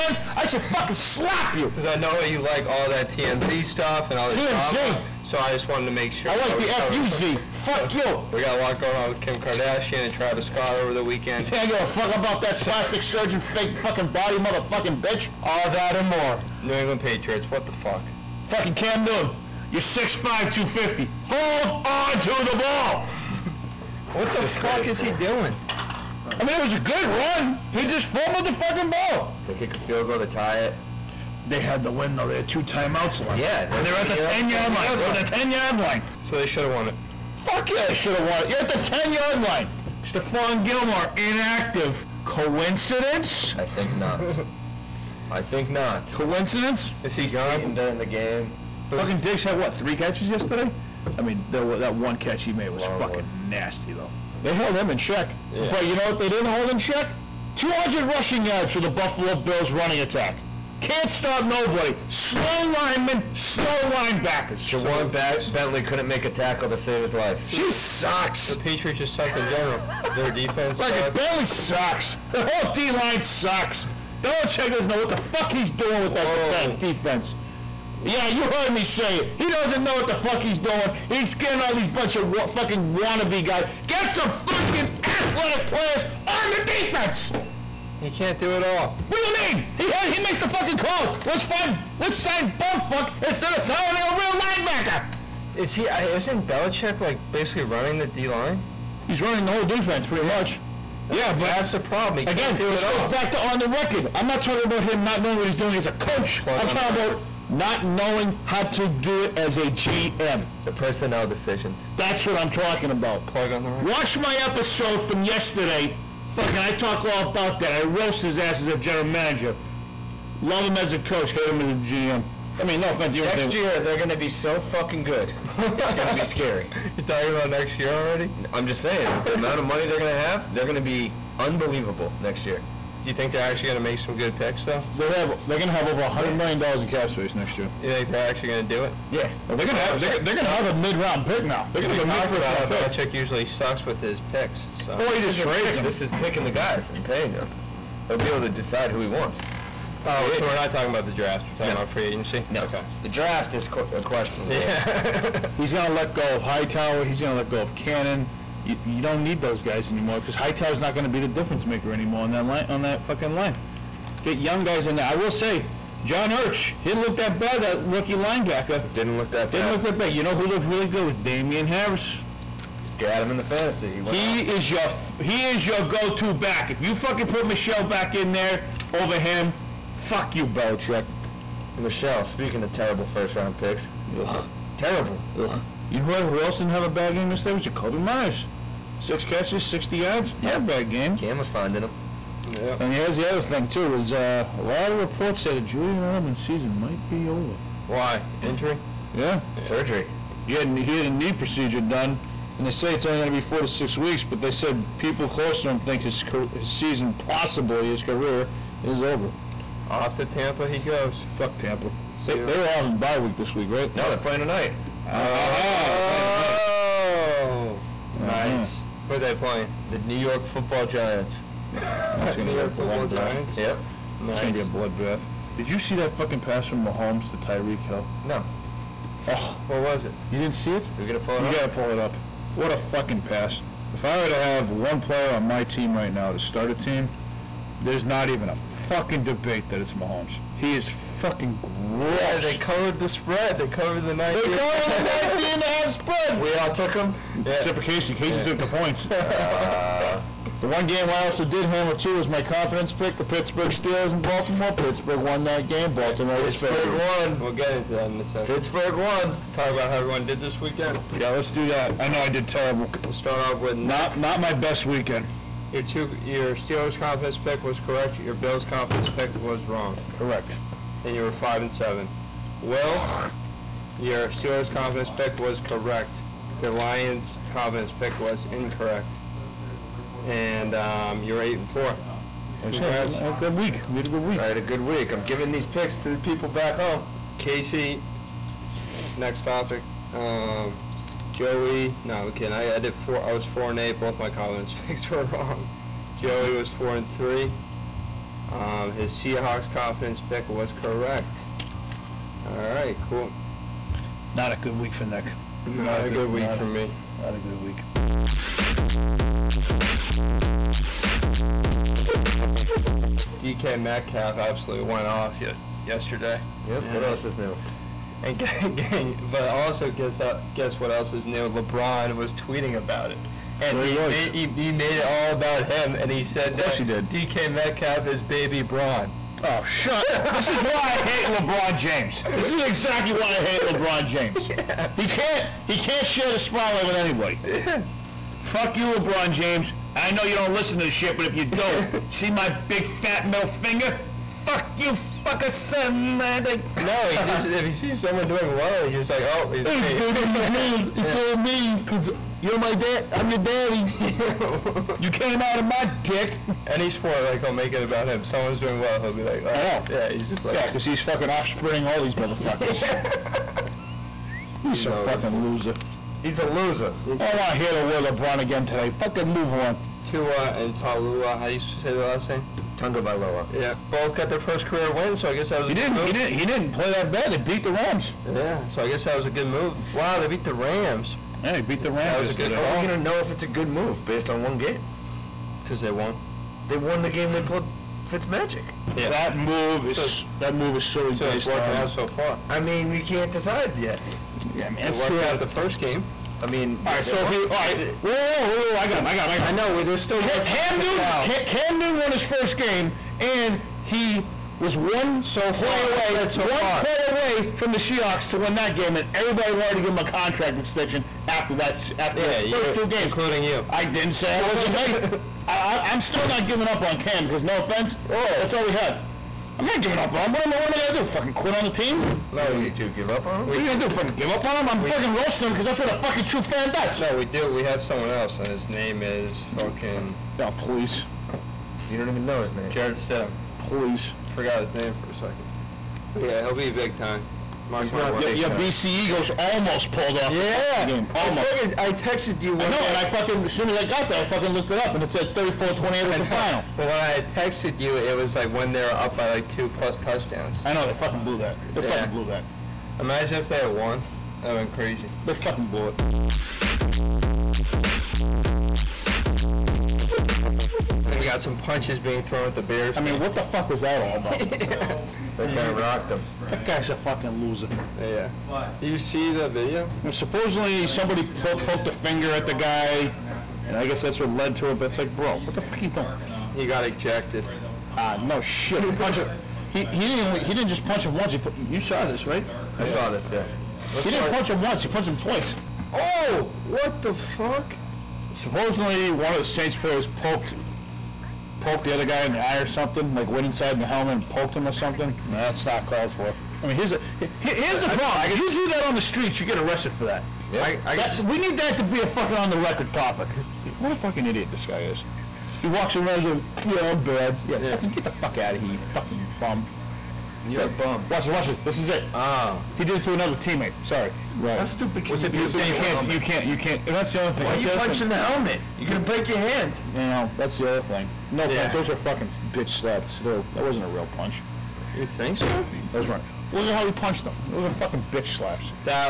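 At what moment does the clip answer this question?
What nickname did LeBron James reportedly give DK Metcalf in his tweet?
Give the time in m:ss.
5:28.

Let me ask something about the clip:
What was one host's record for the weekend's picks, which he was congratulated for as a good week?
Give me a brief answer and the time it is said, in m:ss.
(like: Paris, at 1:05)
8 and 4, at 4:41.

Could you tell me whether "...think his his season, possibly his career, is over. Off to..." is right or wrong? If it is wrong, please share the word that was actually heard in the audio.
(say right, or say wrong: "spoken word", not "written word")
right.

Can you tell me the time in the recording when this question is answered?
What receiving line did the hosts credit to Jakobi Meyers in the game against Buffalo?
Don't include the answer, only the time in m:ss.
3:08.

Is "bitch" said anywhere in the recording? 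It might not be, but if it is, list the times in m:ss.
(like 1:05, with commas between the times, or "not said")
0:14, 8:42, 8:48.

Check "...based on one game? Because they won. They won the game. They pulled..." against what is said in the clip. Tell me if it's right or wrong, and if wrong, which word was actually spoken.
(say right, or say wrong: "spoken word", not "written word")
right.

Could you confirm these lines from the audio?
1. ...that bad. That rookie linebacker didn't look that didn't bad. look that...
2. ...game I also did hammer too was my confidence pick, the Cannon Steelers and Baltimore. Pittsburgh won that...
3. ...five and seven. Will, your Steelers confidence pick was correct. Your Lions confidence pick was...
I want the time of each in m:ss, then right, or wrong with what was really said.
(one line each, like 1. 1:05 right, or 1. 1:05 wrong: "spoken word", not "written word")
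1. 2:47 right
2. 4:10 wrong: "Pittsburgh", not "Cannon"
3. 4:31 right.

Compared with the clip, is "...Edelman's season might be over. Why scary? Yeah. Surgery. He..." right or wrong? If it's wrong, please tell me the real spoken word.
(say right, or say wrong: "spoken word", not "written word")
wrong: "injury", not "scary".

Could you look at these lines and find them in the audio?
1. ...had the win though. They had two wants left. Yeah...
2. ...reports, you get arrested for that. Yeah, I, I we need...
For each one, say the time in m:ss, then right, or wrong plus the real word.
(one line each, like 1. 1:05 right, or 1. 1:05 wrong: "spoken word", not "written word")
1. 0:31 wrong: "timeouts", not "wants"
2. 8:19 wrong: "streets", not "reports".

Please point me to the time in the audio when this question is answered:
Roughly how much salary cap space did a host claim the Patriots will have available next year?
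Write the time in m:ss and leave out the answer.
2:15.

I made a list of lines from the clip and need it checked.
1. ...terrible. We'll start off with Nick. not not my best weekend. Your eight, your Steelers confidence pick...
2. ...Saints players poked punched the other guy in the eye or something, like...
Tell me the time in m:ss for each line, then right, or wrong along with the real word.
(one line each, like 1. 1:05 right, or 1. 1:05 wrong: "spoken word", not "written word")
1. 4:22 wrong: "two", not "eight"
2. 8:09 wrong: "poked", not "punched".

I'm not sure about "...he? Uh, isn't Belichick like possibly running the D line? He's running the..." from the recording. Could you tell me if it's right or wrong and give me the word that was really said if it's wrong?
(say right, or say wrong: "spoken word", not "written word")
wrong: "basically", not "possibly".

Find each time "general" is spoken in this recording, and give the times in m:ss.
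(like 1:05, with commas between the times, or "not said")
1:09, 1:58.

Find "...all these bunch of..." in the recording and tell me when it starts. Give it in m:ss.
1:21.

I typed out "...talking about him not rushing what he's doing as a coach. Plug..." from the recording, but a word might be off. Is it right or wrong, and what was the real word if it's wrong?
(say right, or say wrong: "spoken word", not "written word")
wrong: "knowing", not "rushing".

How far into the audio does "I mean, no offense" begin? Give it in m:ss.
2:02.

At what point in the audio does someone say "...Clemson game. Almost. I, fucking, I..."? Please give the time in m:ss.
7:20.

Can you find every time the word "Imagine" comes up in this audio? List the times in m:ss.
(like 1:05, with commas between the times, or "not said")
7:32.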